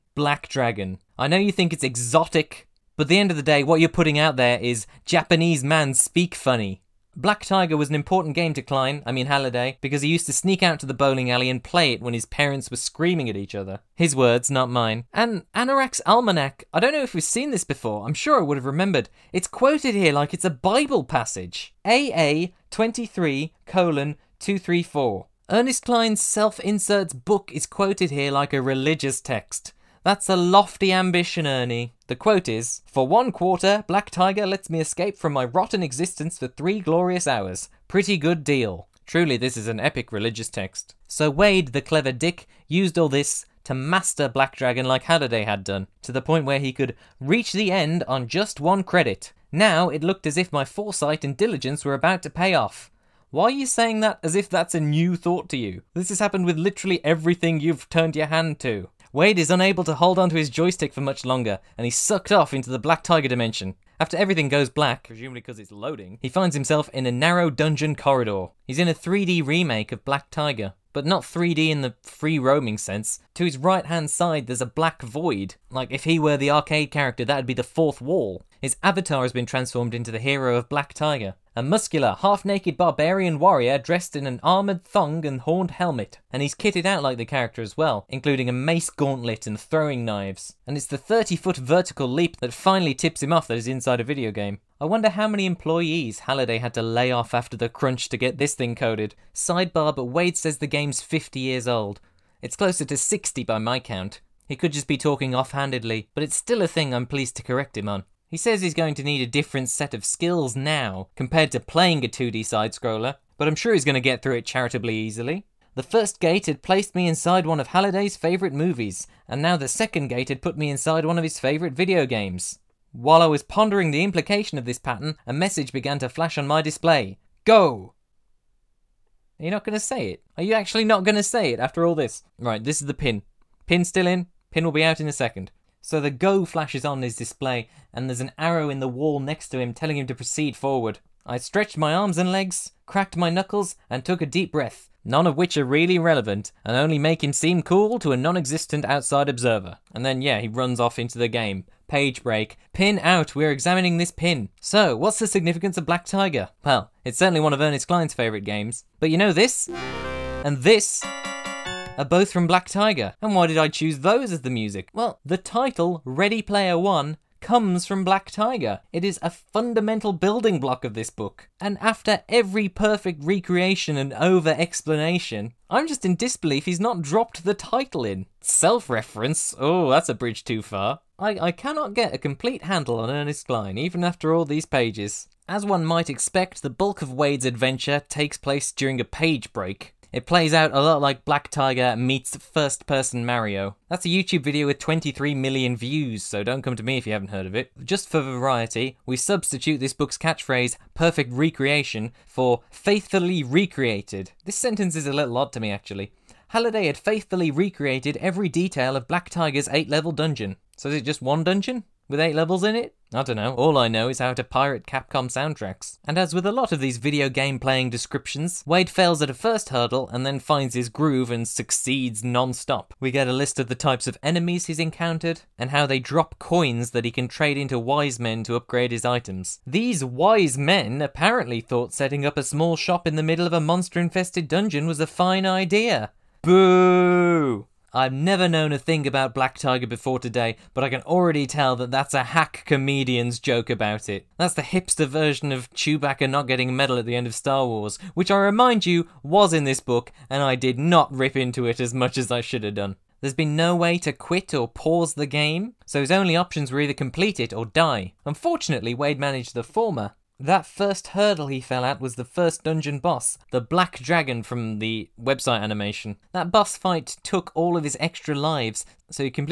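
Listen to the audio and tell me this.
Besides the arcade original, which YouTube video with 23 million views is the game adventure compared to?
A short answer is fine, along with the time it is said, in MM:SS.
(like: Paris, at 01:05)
First Person Mario, at 03:12.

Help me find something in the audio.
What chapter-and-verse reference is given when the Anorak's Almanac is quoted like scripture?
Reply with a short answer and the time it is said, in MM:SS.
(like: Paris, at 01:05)
AA 23:234, at 00:21.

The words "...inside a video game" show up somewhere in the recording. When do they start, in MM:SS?
01:33.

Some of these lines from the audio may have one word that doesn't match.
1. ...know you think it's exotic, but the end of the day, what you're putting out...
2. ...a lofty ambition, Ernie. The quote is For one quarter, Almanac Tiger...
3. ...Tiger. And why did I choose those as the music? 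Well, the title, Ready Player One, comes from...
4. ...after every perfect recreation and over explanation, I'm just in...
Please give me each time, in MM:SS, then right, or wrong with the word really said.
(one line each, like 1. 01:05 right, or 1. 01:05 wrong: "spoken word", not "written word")
1. 00:01 right
2. 00:30 wrong: "Black", not "Almanac"
3. 02:42 right
4. 02:51 right.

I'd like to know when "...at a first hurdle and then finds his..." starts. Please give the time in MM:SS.
03:39.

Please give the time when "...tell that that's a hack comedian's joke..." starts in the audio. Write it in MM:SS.
04:01.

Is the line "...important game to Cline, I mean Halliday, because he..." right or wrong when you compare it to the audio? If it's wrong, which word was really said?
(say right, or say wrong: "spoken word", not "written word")
right.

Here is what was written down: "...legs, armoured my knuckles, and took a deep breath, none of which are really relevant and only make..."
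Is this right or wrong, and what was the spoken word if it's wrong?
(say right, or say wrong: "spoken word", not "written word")
wrong: "cracked", not "armoured".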